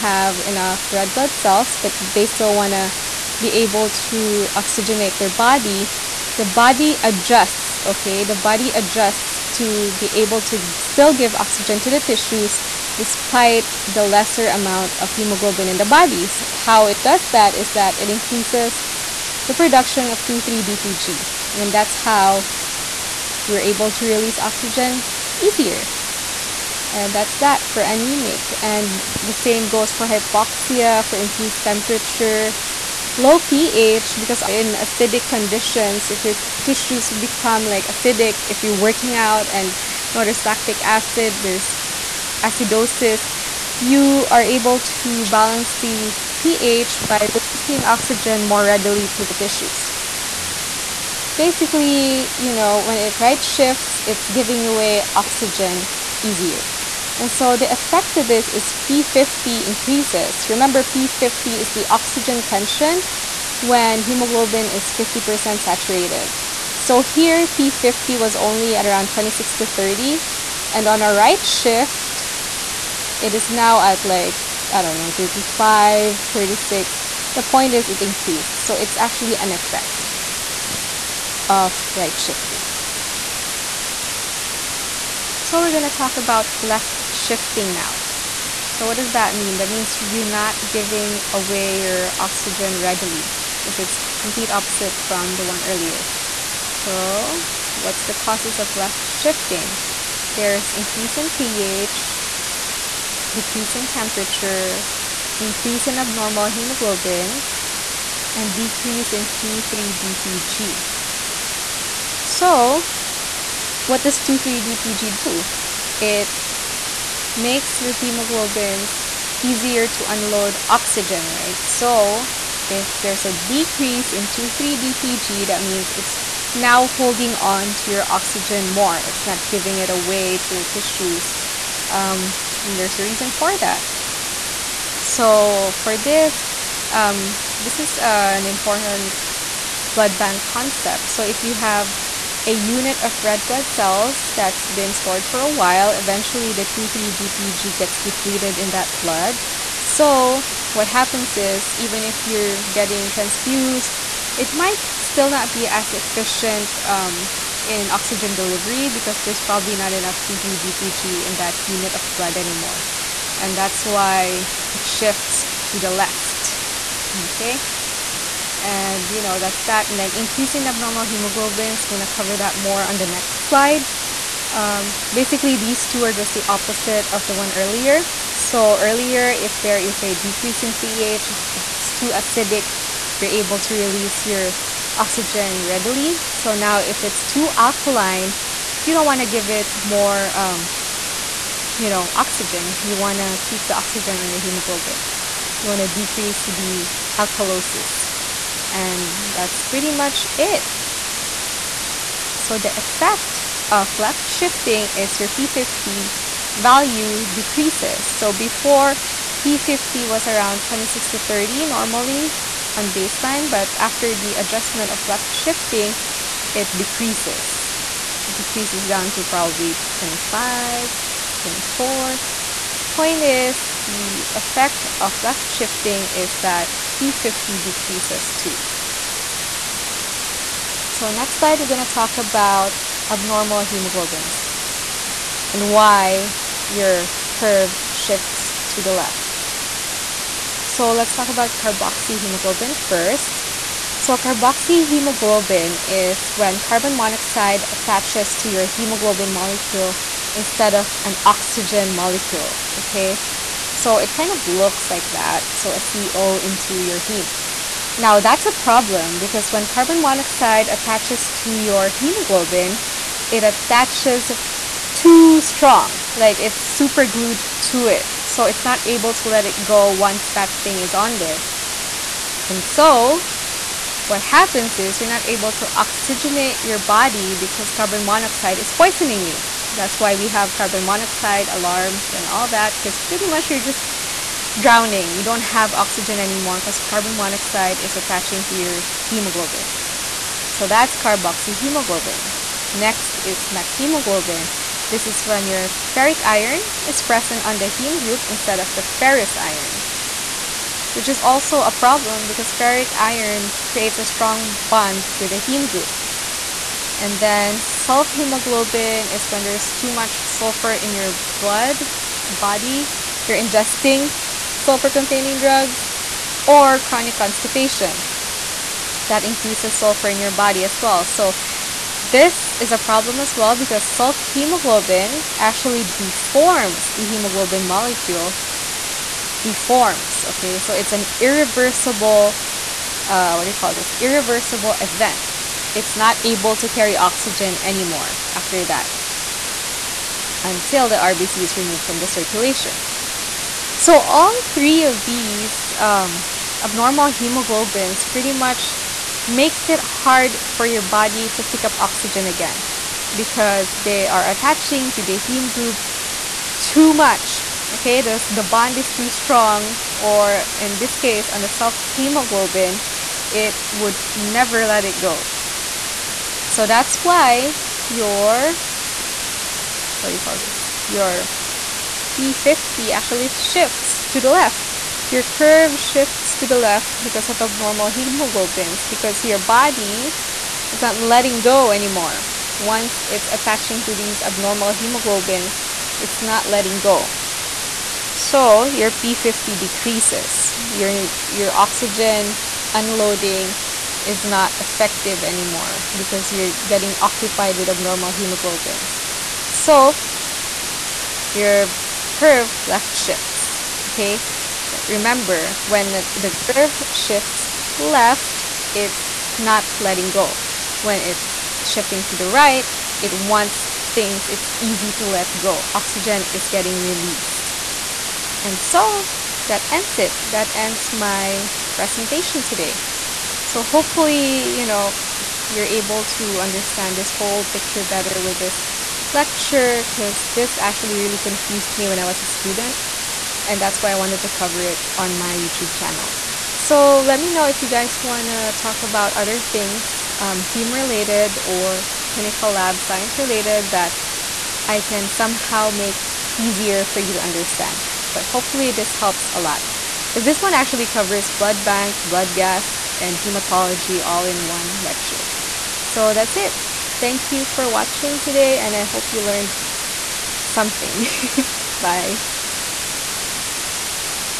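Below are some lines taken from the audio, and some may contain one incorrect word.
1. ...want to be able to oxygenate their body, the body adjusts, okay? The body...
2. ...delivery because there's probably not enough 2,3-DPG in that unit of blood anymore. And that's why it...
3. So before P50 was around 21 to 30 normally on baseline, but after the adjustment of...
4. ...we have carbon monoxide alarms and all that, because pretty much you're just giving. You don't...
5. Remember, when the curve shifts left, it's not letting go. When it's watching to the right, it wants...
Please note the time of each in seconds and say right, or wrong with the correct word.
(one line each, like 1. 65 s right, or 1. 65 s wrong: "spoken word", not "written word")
1. 2 s right
2. 158 s right
3. 208 s wrong: "26", not "21"
4. 280 s wrong: "drowning", not "giving"
5. 404 s wrong: "shifting", not "watching".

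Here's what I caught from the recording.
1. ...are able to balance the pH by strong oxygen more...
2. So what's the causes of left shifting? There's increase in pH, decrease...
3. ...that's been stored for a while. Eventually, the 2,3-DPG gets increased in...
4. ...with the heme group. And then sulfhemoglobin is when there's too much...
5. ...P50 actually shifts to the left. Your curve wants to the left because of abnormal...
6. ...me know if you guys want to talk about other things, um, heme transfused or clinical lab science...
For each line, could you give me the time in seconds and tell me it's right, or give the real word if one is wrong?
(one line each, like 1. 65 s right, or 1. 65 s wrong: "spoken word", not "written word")
1. 44 s wrong: "releasing", not "strong"
2. 96 s right
3. 144 s wrong: "depleted", not "increased"
4. 305 s right
5. 372 s wrong: "shifts", not "wants"
6. 437 s wrong: "related", not "transfused".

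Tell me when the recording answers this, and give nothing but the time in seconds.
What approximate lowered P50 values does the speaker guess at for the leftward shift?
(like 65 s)
219 s.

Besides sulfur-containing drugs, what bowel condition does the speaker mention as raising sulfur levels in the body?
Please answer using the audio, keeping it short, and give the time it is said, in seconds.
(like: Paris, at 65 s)
Chronic constipation, at 316 s.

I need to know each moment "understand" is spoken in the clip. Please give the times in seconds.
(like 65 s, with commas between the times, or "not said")
426 s, 447 s.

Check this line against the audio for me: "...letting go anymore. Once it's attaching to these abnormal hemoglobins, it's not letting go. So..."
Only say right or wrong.
right.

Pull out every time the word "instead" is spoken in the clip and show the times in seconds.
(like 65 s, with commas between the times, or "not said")
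250 s, 298 s.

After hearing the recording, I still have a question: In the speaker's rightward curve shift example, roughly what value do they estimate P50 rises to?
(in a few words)
35, 36.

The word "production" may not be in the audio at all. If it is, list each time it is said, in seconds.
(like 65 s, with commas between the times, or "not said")
19 s.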